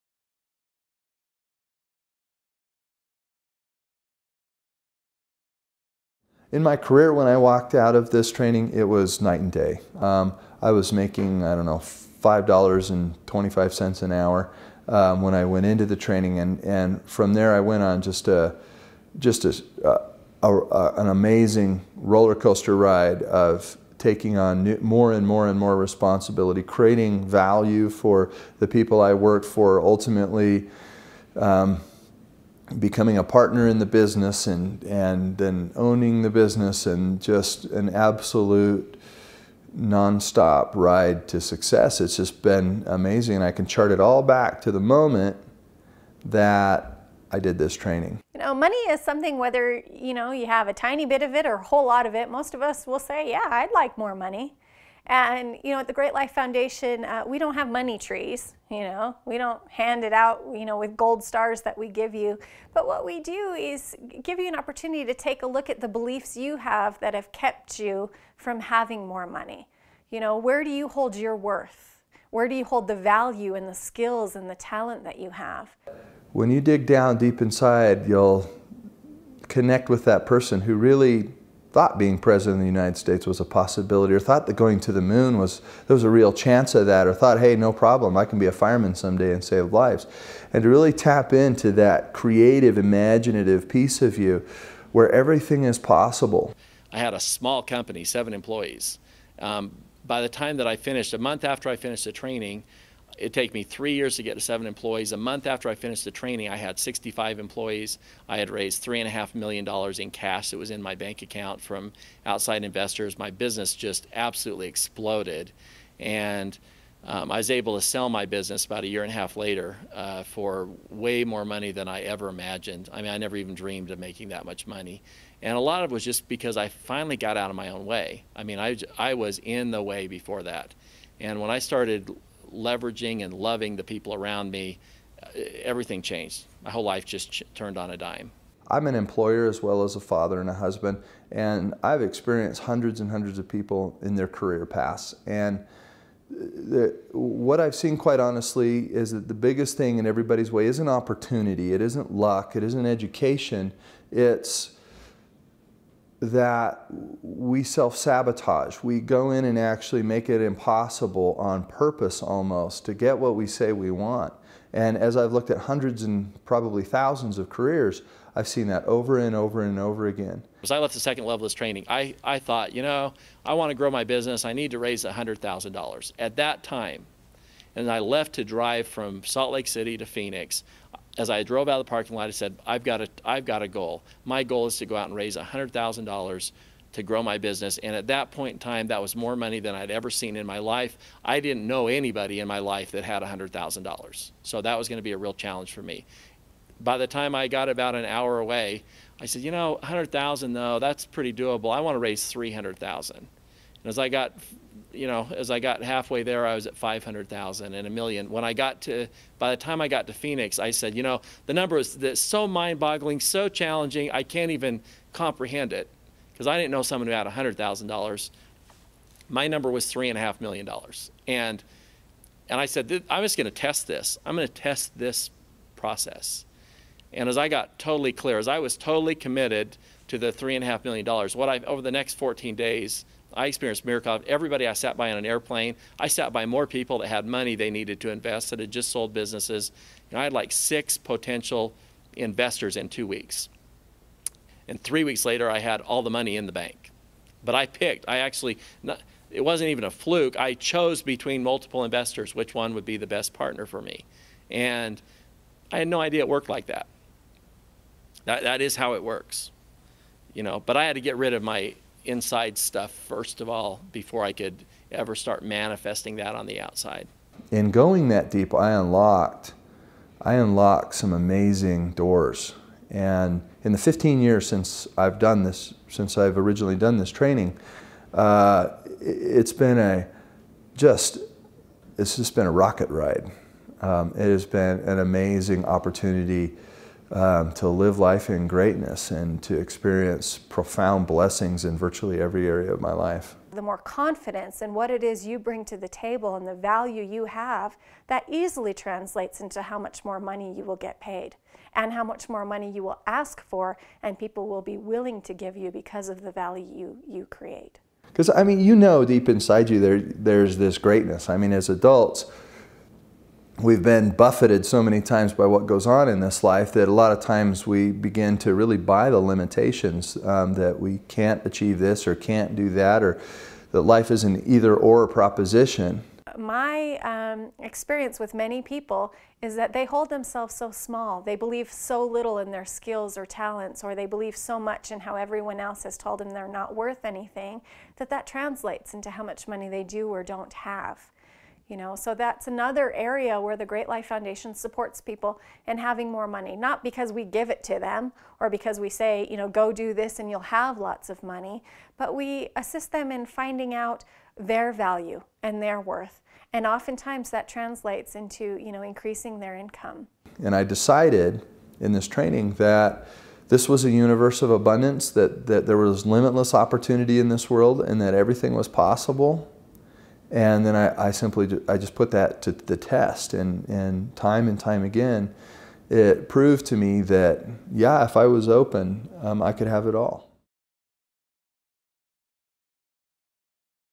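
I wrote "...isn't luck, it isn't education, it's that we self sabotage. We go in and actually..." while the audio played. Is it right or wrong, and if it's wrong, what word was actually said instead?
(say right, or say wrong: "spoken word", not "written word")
right.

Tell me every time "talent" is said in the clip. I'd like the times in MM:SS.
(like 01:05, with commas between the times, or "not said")
01:14, 05:33.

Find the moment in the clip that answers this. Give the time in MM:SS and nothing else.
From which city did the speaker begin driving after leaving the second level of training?
02:59.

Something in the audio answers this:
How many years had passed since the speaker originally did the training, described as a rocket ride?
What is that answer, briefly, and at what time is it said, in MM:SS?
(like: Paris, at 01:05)
15, at 04:33.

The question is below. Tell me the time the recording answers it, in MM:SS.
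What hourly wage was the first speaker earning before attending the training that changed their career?
00:11.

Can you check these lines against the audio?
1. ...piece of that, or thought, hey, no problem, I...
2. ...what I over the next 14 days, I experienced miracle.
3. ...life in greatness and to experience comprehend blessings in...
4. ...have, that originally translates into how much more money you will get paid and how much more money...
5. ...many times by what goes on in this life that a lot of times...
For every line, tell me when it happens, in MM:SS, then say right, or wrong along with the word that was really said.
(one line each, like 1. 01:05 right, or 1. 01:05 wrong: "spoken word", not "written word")
1. 01:26 wrong: "chance", not "piece"
2. 03:51 right
3. 04:47 wrong: "profound", not "comprehend"
4. 04:57 wrong: "easily", not "originally"
5. 05:14 right.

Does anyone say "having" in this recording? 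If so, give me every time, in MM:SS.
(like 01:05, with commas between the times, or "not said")
01:08, 05:45.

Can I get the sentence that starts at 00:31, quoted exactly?
Um, becoming a partner in the business and, and then owning the business and just an absolute nonstop ride to success.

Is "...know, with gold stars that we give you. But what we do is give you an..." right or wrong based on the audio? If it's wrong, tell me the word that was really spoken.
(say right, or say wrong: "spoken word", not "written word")
right.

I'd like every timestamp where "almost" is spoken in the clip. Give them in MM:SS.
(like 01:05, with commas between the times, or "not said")
02:42.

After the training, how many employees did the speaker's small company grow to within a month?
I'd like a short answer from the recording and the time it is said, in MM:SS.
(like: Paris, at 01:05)
65, at 01:46.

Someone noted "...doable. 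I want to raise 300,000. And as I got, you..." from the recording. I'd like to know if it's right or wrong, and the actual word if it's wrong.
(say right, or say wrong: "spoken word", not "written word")
right.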